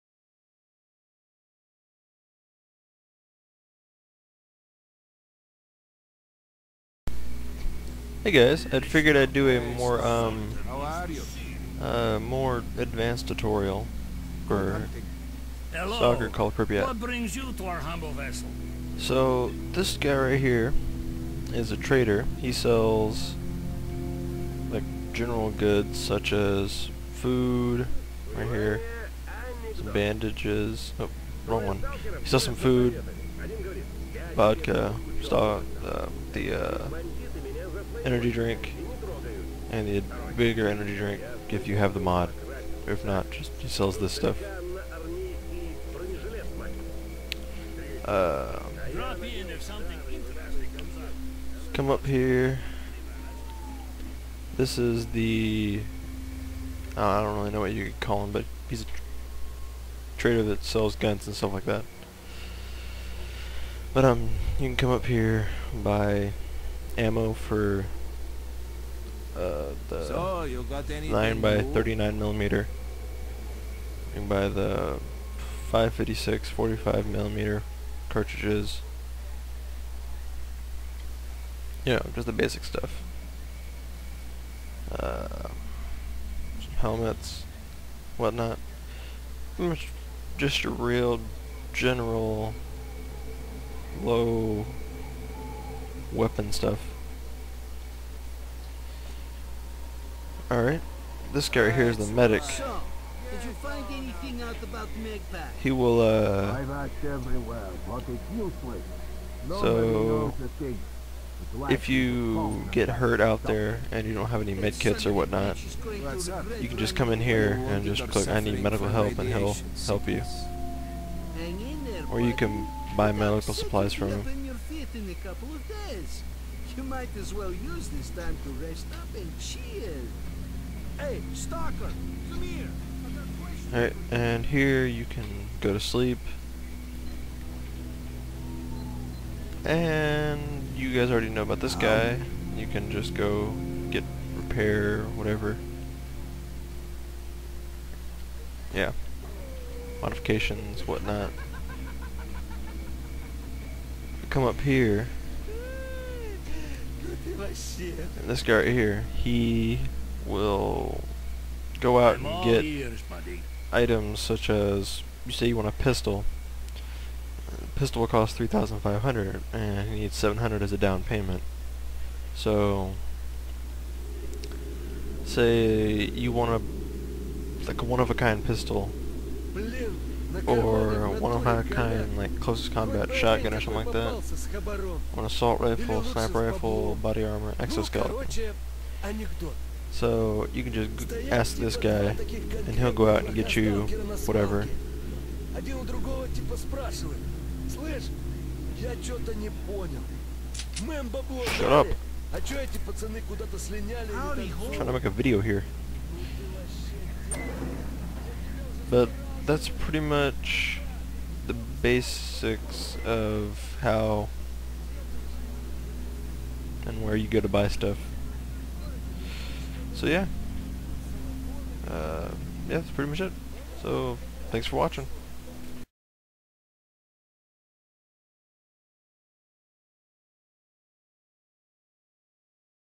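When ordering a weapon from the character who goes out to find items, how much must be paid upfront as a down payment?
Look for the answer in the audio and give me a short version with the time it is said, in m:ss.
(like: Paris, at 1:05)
700, at 2:50.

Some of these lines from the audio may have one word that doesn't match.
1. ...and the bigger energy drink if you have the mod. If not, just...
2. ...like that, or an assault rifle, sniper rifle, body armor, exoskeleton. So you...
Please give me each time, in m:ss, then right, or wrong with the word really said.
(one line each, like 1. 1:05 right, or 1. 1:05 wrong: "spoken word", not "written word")
1. 0:39 right
2. 3:03 right.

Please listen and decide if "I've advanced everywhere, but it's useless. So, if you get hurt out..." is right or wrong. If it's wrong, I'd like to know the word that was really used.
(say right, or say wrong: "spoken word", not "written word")
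wrong: "asked", not "advanced".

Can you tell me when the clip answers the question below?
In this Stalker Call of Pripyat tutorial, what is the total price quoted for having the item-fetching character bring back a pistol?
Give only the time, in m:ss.
2:48.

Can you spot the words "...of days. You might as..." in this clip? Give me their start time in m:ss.
2:05.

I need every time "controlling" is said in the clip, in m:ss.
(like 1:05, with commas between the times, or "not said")
not said.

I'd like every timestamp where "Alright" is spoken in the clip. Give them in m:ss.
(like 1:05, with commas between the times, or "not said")
1:40, 2:13.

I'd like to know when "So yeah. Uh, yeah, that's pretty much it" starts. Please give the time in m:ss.
3:39.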